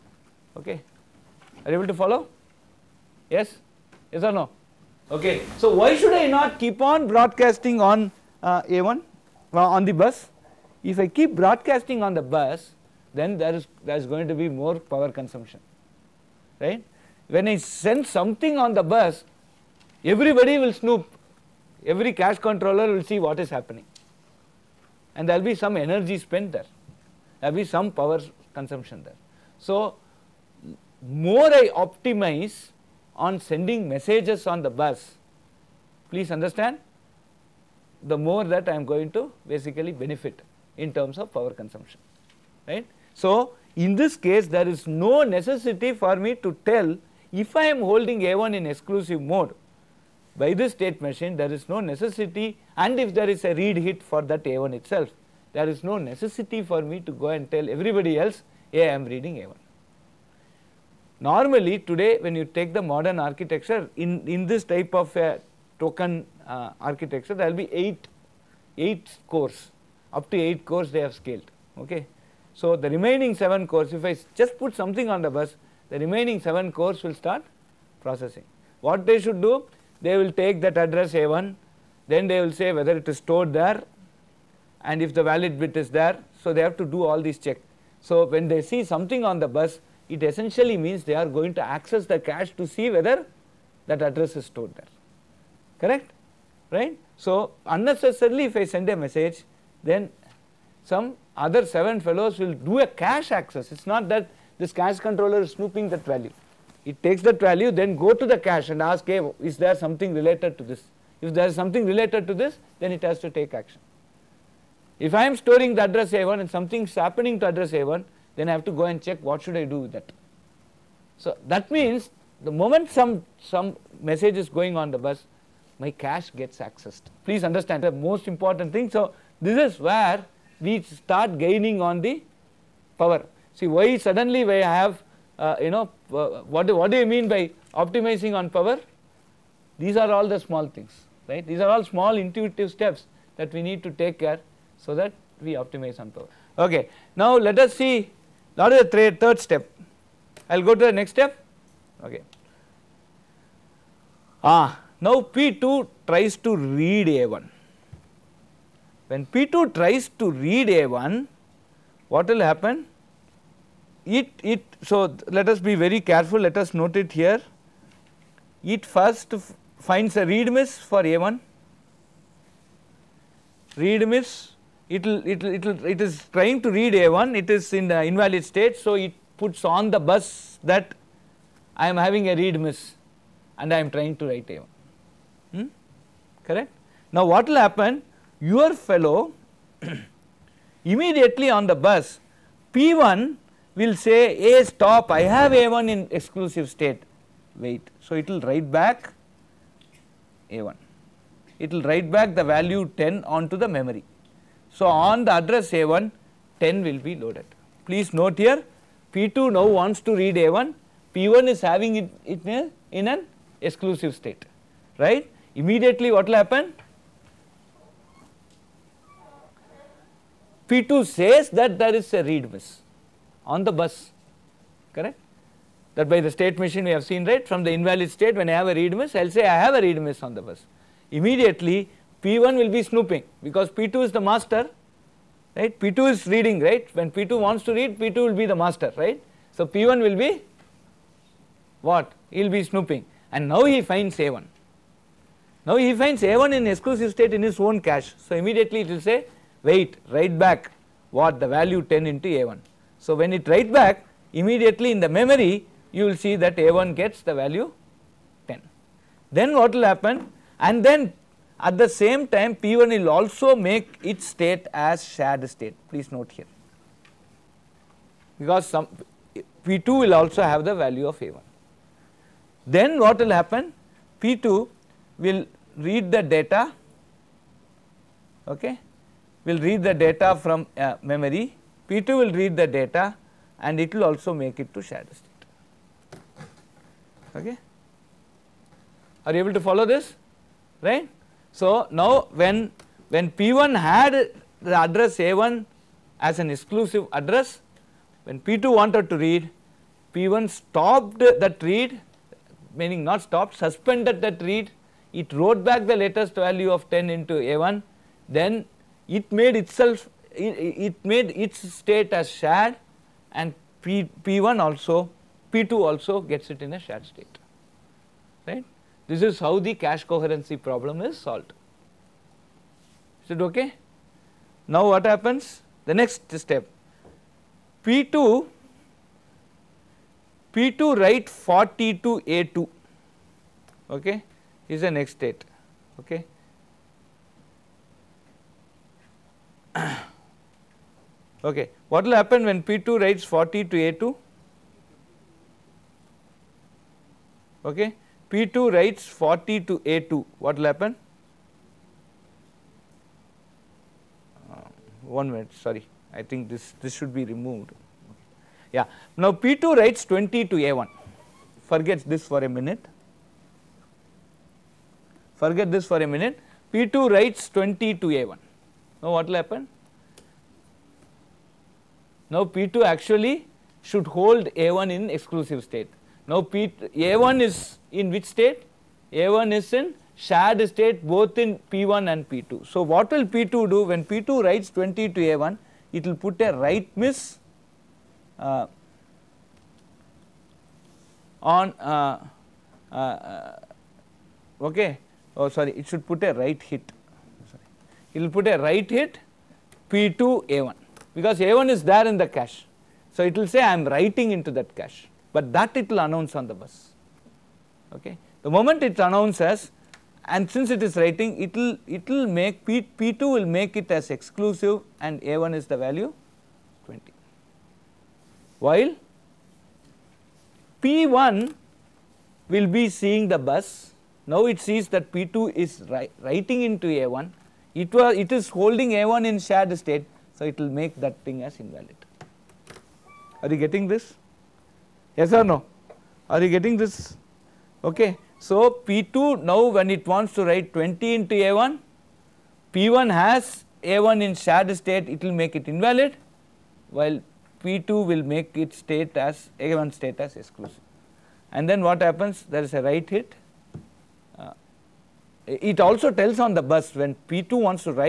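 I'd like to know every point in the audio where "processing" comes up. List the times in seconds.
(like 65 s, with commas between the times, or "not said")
77 s.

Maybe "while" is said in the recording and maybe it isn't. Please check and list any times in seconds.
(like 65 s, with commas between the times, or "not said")
418 s, 446 s.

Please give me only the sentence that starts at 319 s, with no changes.
This is how the cache coherency problem is solved.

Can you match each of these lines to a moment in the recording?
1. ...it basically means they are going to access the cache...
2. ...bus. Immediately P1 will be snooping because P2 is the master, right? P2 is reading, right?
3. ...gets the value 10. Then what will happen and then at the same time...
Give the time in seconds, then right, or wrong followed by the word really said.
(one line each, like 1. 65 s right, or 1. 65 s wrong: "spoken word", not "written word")
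1. 90 s wrong: "essentially", not "basically"
2. 230 s right
3. 256 s right.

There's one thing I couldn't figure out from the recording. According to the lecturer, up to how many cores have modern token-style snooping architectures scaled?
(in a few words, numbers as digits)
8.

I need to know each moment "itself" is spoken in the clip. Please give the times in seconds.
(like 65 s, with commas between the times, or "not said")
54 s, 309 s.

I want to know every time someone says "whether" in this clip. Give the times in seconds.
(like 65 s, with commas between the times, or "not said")
82 s, 92 s.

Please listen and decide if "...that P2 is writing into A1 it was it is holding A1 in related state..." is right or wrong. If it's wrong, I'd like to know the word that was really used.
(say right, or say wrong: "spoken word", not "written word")
wrong: "shared", not "related".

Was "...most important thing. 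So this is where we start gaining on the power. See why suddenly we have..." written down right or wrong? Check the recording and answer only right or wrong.
right.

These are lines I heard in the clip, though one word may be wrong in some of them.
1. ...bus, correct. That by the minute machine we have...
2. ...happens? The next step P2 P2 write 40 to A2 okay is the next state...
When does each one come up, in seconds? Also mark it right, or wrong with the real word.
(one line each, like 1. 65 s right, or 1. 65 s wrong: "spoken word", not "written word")
1. 223 s wrong: "state", not "minute"
2. 325 s right.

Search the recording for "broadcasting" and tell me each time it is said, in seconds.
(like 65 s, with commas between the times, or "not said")
7 s, 11 s.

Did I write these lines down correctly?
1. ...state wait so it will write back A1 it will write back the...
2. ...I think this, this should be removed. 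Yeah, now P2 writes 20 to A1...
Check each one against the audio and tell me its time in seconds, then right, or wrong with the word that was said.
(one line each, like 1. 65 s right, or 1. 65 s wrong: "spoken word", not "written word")
1. 196 s right
2. 356 s right.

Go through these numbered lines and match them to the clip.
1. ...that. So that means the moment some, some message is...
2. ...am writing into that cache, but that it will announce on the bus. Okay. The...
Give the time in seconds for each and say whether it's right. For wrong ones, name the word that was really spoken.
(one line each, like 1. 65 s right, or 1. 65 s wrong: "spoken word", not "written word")
1. 119 s right
2. 403 s right.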